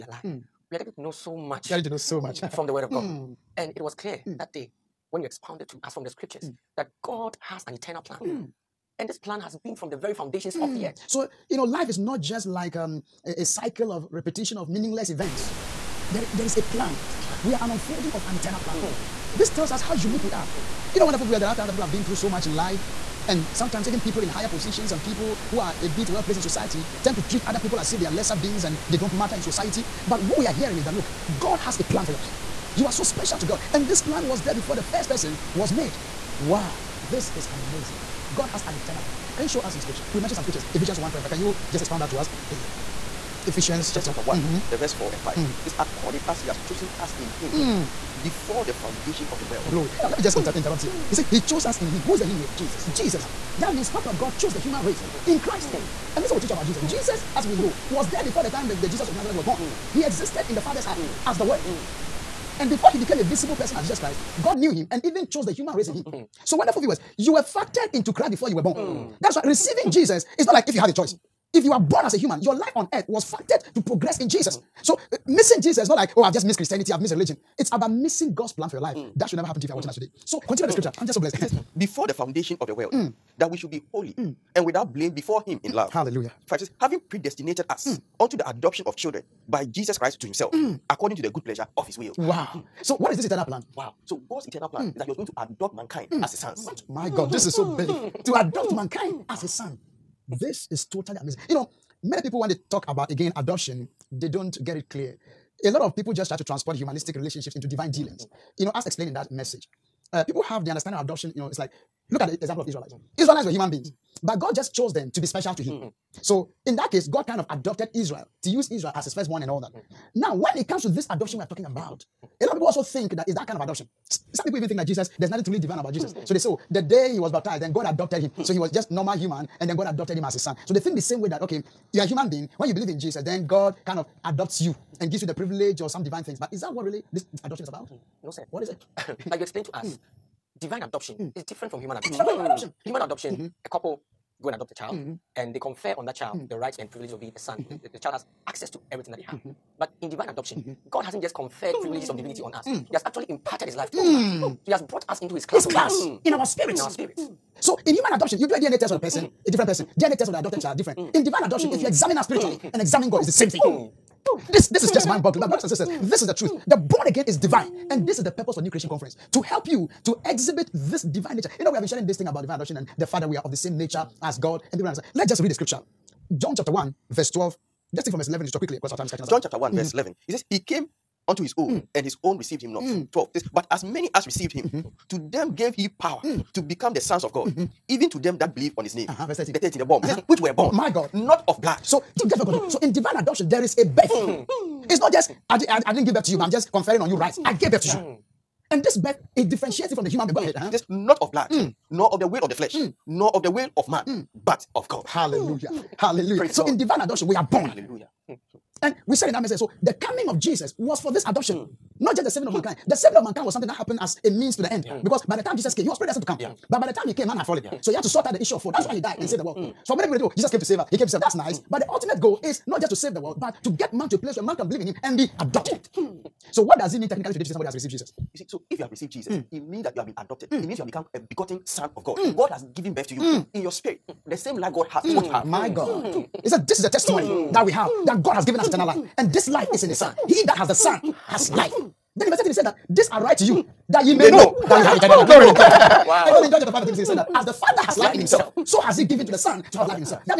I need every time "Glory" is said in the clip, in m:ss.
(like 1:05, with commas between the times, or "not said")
0:49, 4:05.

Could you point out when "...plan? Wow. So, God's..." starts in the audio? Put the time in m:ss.
1:33.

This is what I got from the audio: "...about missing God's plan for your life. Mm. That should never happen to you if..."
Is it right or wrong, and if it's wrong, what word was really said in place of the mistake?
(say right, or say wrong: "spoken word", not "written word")
right.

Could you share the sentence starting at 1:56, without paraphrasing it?
So in that case, God kind of adopted Israel to use Israel as his firstborn and all that.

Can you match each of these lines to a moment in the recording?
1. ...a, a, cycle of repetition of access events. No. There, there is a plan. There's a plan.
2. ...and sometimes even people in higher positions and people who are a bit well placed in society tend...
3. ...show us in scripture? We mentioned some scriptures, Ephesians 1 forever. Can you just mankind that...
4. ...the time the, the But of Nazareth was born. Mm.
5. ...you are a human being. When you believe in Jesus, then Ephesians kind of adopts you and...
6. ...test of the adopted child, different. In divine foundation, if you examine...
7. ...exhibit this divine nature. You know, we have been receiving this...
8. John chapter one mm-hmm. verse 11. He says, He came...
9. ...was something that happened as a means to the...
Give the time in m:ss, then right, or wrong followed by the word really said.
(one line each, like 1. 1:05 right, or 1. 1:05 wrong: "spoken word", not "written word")
1. 0:13 wrong: "meaningless", not "access"
2. 0:23 right
3. 0:39 wrong: "expound", not "mankind"
4. 0:58 wrong: "Jesus", not "But"
5. 2:11 wrong: "God", not "Ephesians"
6. 2:40 wrong: "adoption", not "foundation"
7. 2:50 wrong: "sharing", not "receiving"
8. 2:59 right
9. 3:33 right.